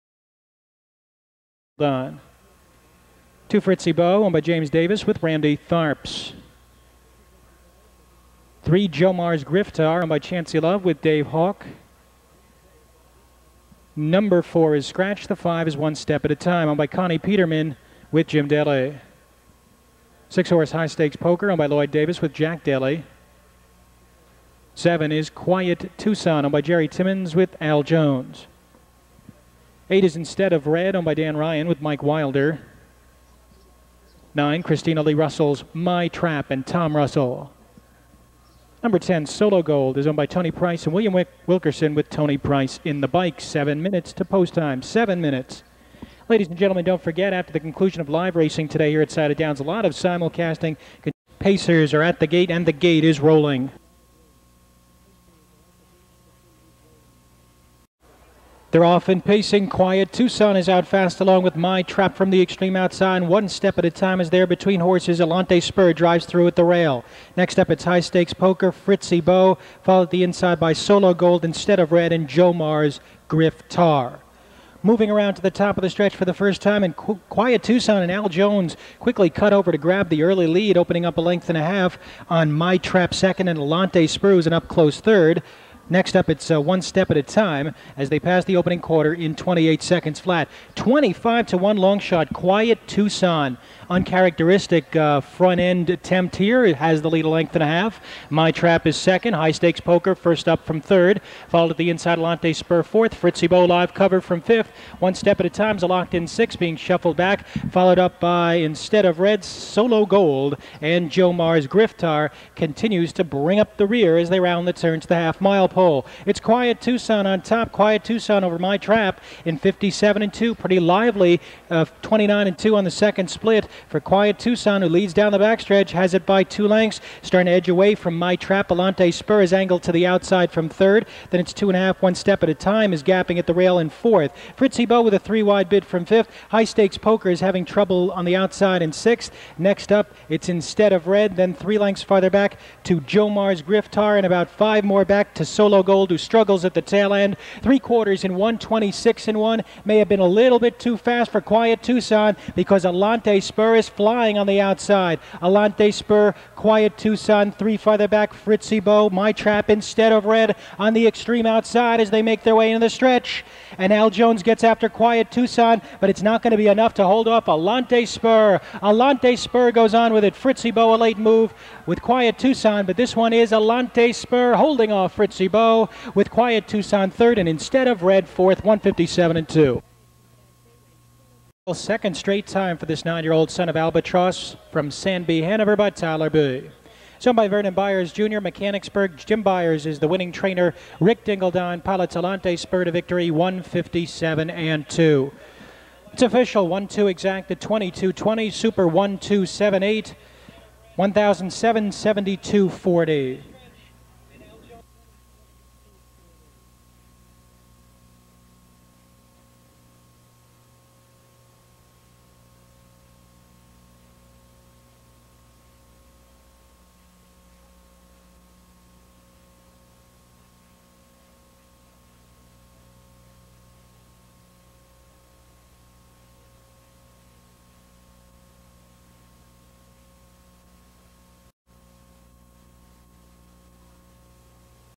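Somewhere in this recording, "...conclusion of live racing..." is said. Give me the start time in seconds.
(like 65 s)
47 s.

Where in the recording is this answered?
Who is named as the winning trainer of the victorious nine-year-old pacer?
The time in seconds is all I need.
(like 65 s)
189 s.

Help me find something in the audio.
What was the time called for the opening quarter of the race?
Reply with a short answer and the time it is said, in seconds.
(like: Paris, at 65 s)
28 seconds, at 89 s.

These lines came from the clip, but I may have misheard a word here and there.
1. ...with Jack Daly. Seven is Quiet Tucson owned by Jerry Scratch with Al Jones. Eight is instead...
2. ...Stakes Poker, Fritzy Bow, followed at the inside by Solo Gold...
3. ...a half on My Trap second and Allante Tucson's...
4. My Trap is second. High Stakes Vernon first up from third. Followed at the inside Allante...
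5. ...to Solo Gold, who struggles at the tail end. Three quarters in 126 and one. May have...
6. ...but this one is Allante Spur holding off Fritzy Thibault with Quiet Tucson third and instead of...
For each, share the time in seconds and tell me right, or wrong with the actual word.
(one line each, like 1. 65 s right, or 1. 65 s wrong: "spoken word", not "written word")
1. 22 s wrong: "Timmons", not "Scratch"
2. 67 s right
3. 81 s wrong: "Spur", not "Tucson"
4. 98 s wrong: "Poker", not "Vernon"
5. 145 s right
6. 172 s right.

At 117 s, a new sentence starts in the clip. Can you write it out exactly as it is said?
Quiet Tucson over my trap in 57 and 2.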